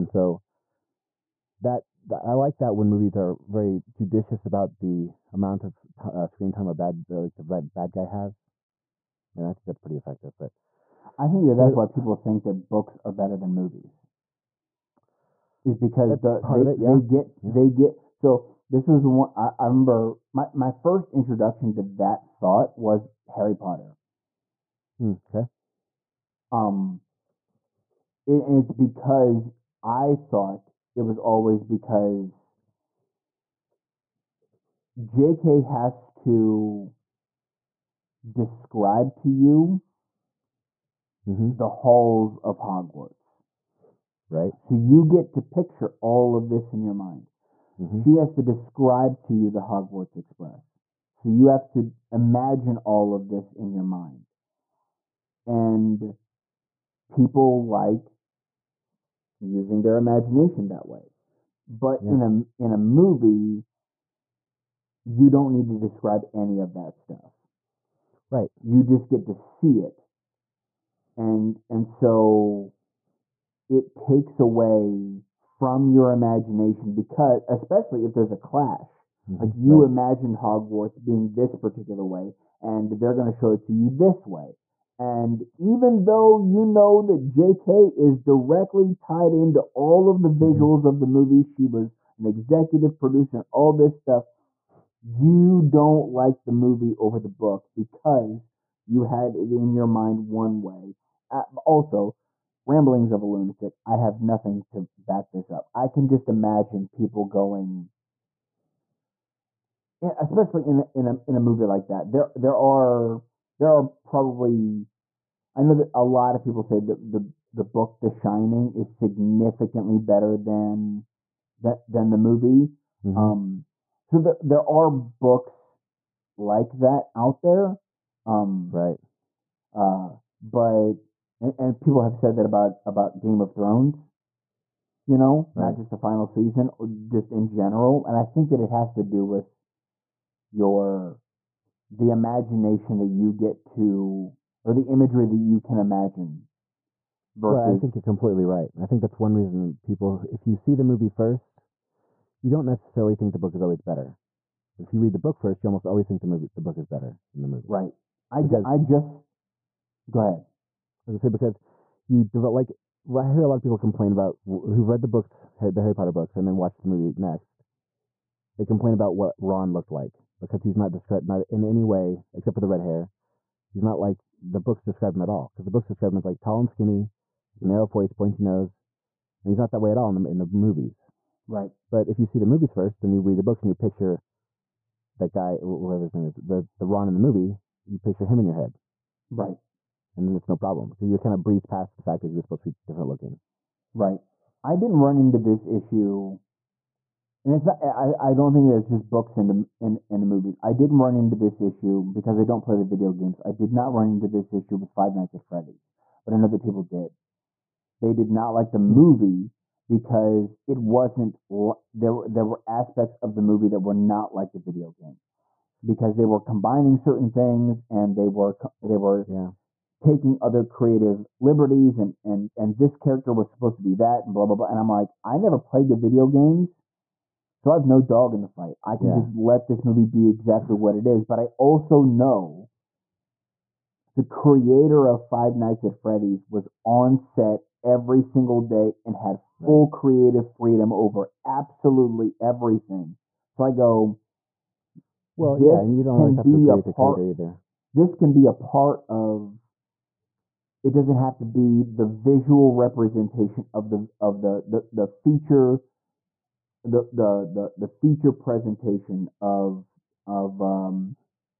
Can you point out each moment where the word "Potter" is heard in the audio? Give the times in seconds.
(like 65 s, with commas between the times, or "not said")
23 s, 165 s.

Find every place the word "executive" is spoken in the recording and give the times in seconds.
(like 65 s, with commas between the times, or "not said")
92 s.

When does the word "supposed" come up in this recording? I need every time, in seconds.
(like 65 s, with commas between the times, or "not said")
192 s, 223 s.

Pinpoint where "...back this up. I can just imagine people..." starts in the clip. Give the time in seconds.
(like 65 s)
104 s.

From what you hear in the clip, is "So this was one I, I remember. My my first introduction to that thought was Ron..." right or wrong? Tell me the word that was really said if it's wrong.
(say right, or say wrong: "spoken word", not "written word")
wrong: "Harry", not "Ron".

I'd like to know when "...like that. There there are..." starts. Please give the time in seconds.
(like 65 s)
111 s.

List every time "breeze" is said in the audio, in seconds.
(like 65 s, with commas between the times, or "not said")
191 s.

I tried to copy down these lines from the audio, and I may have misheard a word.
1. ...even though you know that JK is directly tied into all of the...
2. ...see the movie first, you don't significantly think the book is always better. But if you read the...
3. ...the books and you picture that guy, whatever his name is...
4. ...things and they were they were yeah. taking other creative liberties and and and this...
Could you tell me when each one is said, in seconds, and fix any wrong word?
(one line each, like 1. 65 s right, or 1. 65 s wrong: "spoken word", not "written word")
1. 85 s right
2. 150 s wrong: "necessarily", not "significantly"
3. 183 s right
4. 217 s right.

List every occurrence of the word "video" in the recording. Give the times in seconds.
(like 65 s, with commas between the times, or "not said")
202 s, 214 s, 225 s.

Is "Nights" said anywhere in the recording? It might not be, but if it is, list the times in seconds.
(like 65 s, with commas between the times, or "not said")
205 s, 235 s.